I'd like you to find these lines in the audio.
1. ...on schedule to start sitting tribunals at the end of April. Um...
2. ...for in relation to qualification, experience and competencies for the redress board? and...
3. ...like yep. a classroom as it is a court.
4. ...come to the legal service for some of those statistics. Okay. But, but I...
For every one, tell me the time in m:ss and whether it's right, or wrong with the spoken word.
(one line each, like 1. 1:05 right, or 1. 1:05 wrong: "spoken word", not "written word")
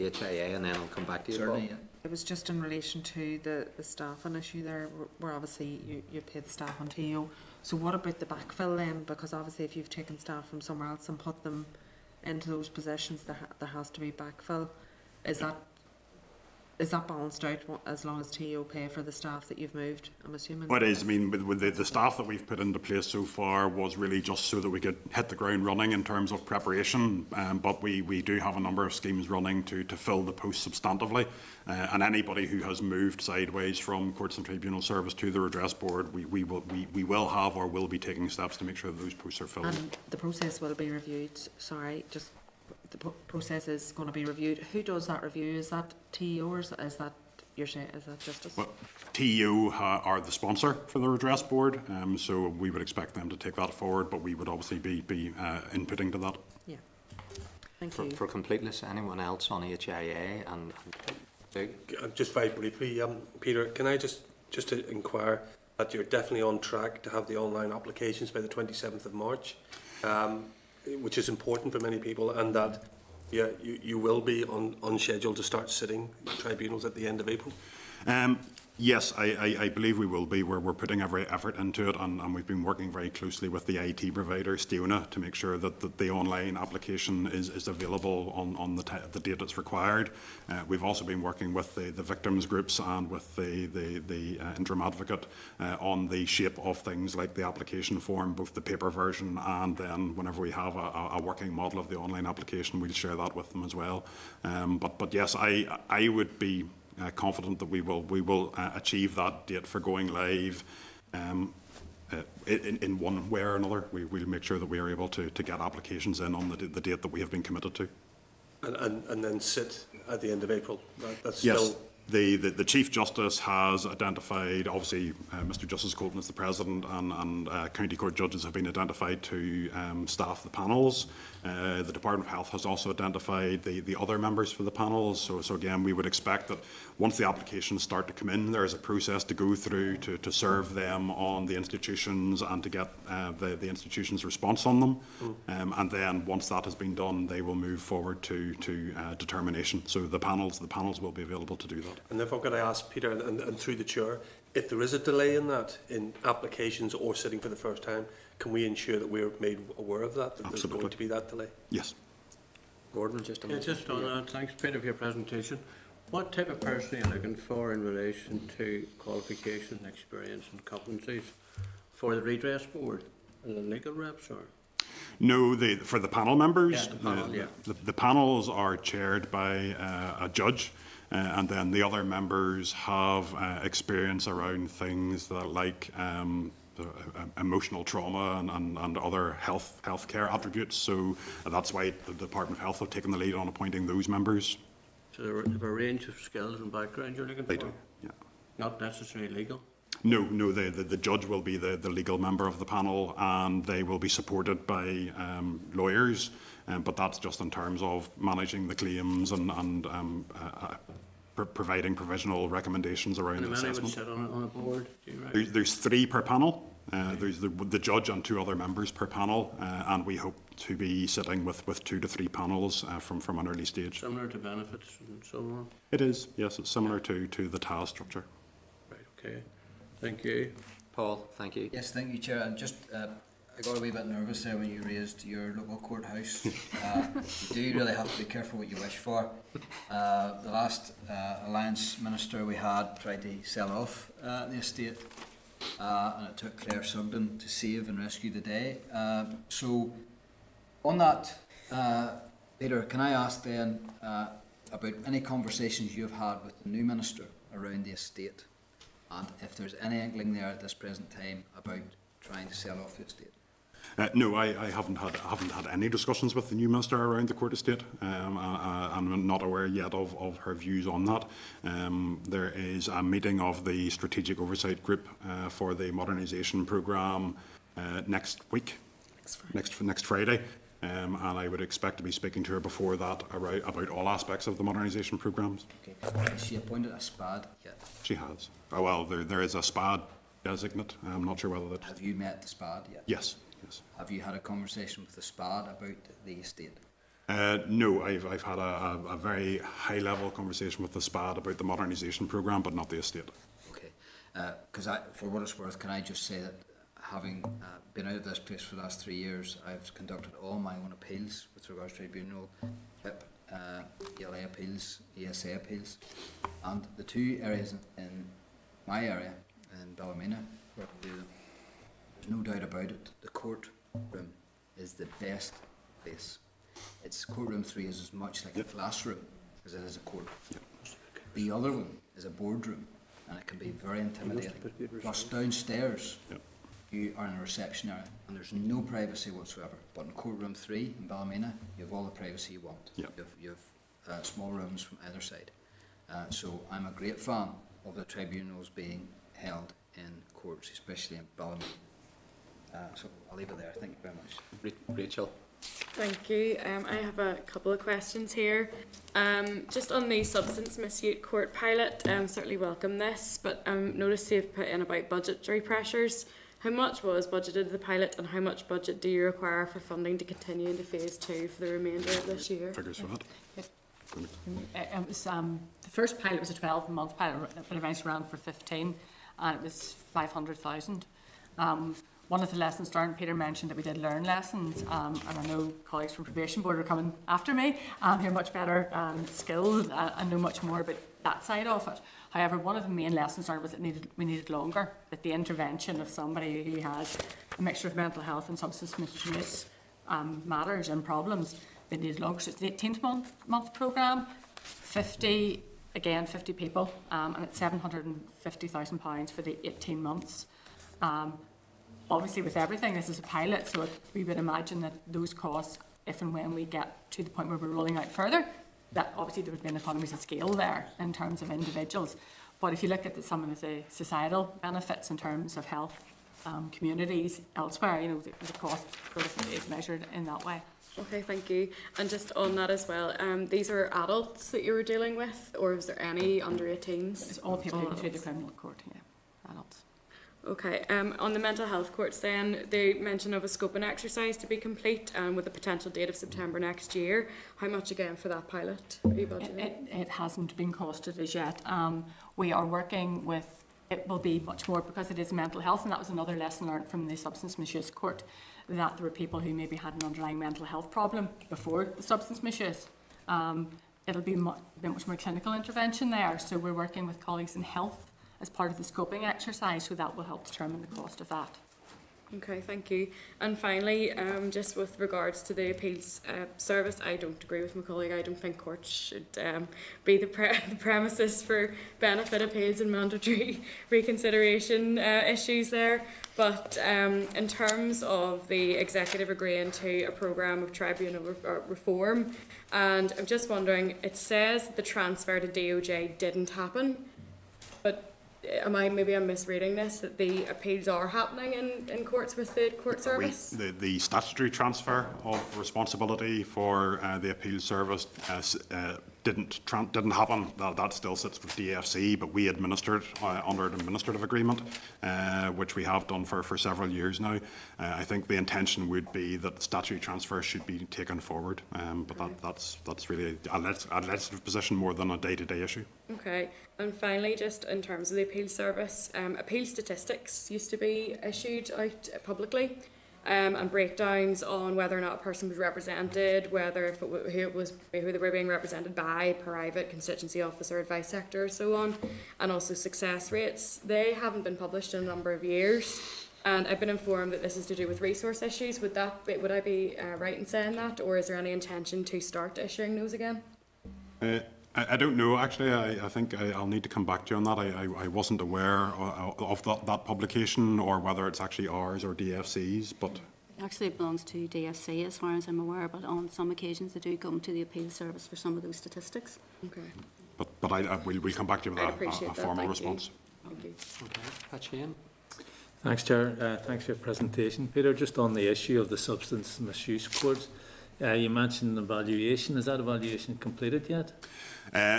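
1. 1:14 right
2. 2:47 right
3. 5:28 right
4. 9:27 wrong: "appeal", not "legal".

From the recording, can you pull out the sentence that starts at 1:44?
Um, but, but yes, I, I would be uh, confident that we will we will uh, achieve that date for going live.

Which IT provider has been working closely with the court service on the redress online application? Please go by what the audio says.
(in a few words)
Stiona.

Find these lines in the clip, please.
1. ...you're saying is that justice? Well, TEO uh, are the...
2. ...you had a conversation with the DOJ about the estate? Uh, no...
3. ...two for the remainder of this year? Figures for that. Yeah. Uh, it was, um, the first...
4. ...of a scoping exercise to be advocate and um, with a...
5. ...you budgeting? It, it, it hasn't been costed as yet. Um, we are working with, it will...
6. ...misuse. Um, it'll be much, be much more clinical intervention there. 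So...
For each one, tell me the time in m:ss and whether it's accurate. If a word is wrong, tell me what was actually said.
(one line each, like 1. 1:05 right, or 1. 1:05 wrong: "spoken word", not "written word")
1. 0:47 right
2. 4:54 wrong: "SPAD", not "DOJ"
3. 6:11 right
4. 7:23 wrong: "complete", not "advocate"
5. 7:29 right
6. 7:42 right.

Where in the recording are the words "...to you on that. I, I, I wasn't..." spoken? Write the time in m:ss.
9:17.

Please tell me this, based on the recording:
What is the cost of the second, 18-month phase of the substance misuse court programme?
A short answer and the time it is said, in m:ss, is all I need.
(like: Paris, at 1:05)
£750,000, at 6:47.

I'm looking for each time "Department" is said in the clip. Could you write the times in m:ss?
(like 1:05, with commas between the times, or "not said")
2:11, 3:12.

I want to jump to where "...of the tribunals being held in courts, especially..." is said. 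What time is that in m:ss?
5:47.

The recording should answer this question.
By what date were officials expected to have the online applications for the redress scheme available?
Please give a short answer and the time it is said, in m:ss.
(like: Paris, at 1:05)
27th of March, at 1:08.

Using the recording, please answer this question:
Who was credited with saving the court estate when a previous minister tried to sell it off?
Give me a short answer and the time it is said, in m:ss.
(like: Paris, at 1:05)
Claire Sugden, at 4:06.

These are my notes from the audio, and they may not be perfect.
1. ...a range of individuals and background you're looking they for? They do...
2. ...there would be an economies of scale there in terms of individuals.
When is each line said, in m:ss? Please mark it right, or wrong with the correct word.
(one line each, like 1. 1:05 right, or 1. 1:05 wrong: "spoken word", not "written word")
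1. 3:15 wrong: "skills", not "individuals"
2. 6:59 right.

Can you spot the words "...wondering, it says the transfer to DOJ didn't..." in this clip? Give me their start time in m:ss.
8:13.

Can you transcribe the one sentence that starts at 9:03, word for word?
They haven't been published in a number of years, and I've been informed that this is to do with resource issues.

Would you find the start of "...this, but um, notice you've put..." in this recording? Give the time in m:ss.
6:02.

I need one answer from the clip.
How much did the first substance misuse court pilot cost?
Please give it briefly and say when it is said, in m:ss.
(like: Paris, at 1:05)
500,000, at 6:20.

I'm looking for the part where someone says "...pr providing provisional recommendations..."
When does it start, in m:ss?
3:31.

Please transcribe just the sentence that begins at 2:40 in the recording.
there's going to be that delay?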